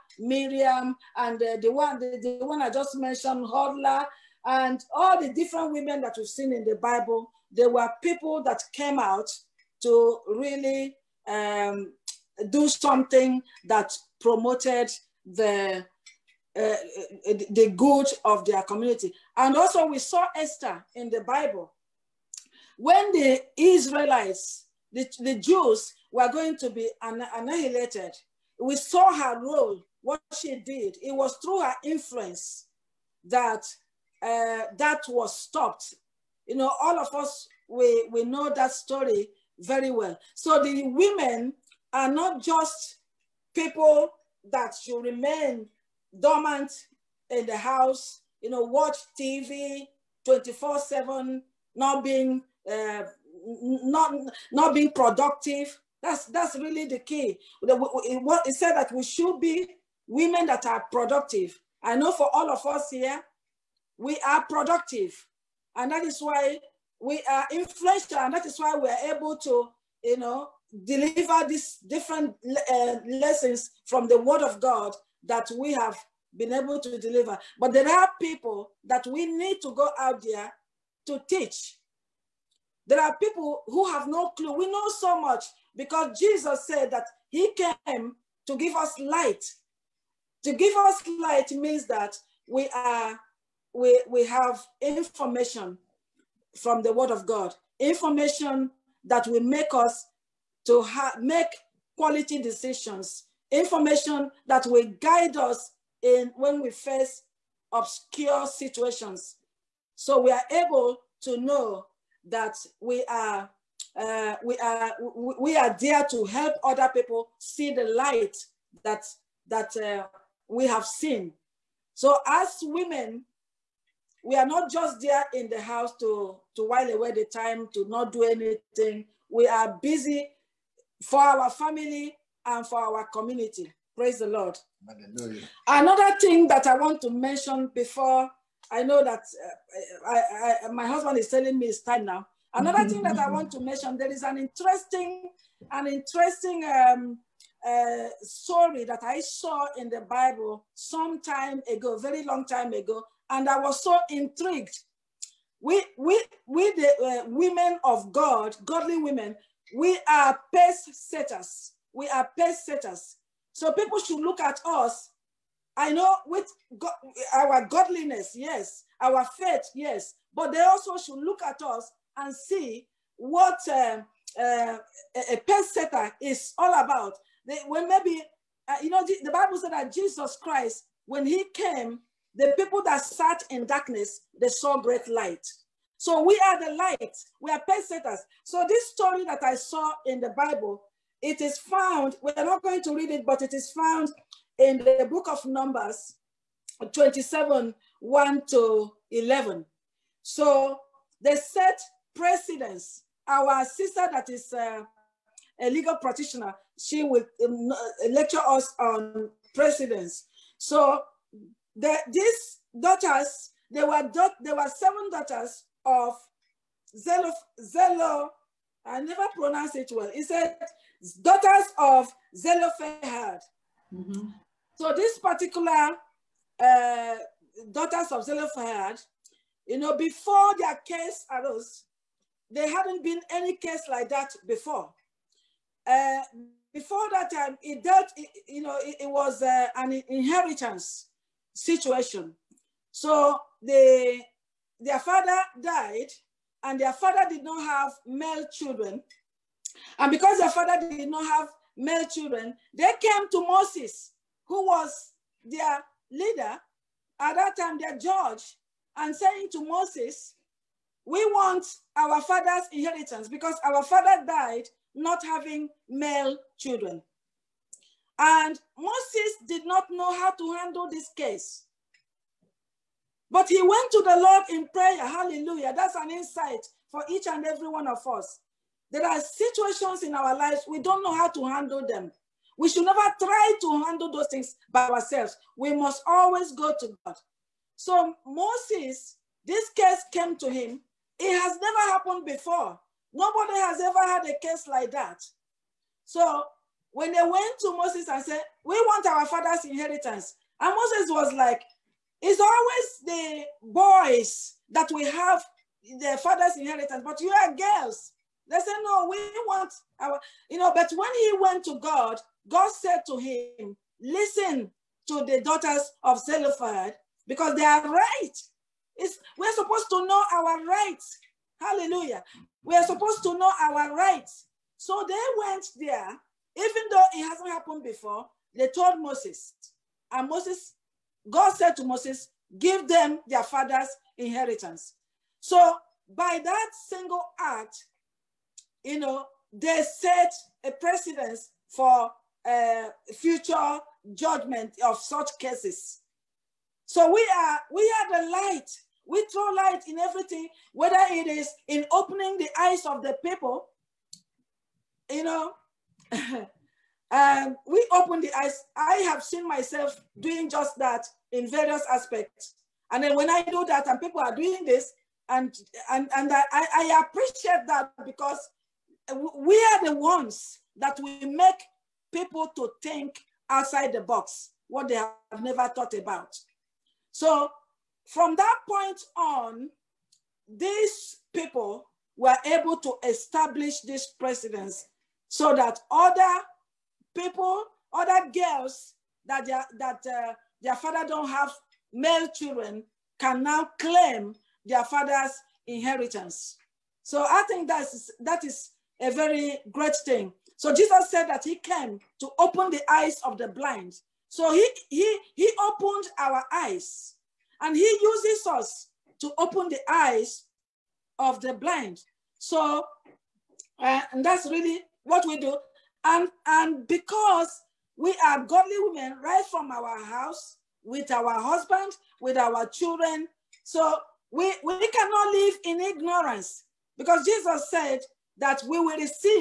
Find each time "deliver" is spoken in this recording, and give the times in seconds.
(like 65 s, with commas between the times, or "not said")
70 s, 76 s.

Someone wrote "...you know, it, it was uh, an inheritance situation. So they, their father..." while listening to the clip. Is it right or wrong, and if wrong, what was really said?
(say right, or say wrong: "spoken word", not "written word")
right.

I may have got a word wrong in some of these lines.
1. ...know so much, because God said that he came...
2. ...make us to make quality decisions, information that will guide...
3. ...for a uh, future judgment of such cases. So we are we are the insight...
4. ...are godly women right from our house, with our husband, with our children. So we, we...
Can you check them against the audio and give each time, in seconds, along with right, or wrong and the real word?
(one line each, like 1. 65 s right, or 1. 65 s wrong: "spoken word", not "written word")
1. 84 s wrong: "Jesus", not "God"
2. 99 s right
3. 341 s wrong: "light", not "insight"
4. 418 s right.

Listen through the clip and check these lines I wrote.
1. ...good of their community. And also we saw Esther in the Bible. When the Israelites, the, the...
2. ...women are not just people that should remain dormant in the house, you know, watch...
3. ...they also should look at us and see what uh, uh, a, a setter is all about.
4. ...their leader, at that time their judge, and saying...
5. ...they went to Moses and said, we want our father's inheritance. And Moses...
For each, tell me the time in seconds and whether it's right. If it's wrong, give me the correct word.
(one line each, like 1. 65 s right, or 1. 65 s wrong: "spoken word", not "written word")
1. 17 s right
2. 40 s right
3. 170 s right
4. 255 s right
5. 297 s right.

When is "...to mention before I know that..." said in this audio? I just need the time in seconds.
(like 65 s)
137 s.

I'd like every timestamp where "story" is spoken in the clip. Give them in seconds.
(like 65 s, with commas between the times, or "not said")
38 s, 148 s, 188 s.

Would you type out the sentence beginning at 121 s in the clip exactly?
So as women, we are not just there in the house to, to while away the time, to not do anything.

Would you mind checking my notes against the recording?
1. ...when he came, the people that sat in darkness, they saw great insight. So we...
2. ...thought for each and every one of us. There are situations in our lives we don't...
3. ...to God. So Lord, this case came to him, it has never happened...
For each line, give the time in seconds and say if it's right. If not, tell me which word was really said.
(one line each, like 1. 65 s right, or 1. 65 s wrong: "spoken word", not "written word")
1. 181 s wrong: "light", not "insight"
2. 276 s wrong: "insight", not "thought"
3. 286 s wrong: "Moses", not "Lord".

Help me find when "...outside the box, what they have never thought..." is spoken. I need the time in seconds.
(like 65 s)
373 s.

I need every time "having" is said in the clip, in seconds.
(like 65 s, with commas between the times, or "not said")
265 s.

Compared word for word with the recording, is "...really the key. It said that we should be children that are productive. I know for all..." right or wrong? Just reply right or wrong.
wrong.